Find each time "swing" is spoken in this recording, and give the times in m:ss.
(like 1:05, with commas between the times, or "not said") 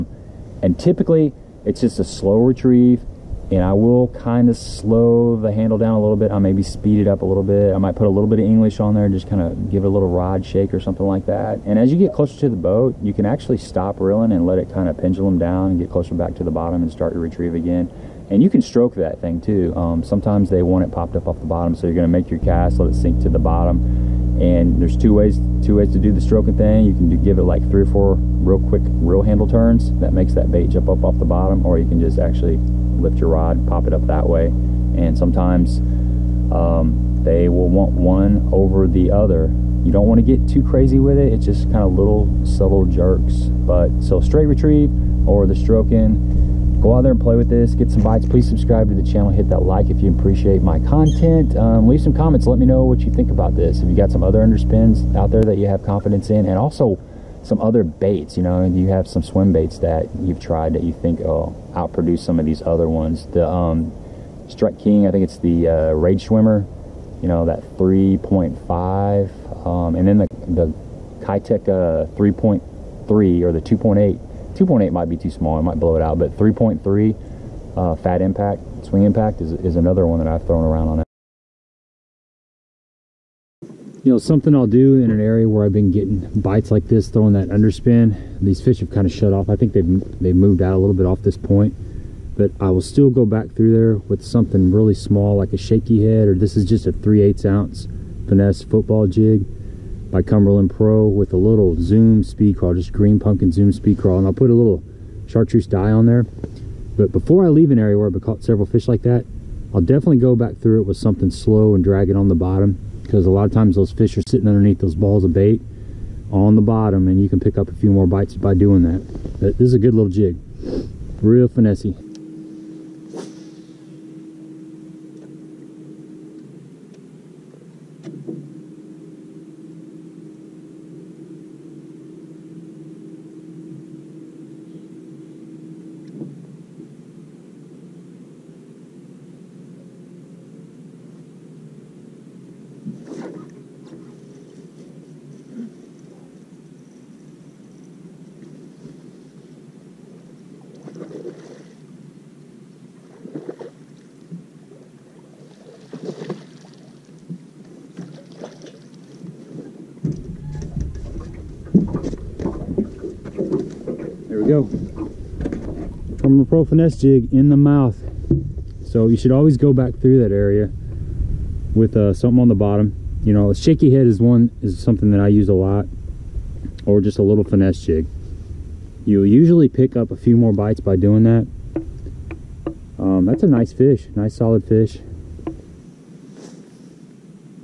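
1:18.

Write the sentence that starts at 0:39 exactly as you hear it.
You don't want to get too crazy with it.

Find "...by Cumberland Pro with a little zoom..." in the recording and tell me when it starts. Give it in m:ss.
1:40.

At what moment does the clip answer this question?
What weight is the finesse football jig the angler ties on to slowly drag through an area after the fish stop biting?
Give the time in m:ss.
1:36.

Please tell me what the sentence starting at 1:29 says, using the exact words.
I think they've, they've moved out a little bit off this point.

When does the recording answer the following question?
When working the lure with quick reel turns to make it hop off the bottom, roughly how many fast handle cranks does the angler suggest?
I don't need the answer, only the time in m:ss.
0:27.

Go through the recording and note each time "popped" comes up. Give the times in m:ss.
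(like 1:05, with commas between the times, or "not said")
0:20.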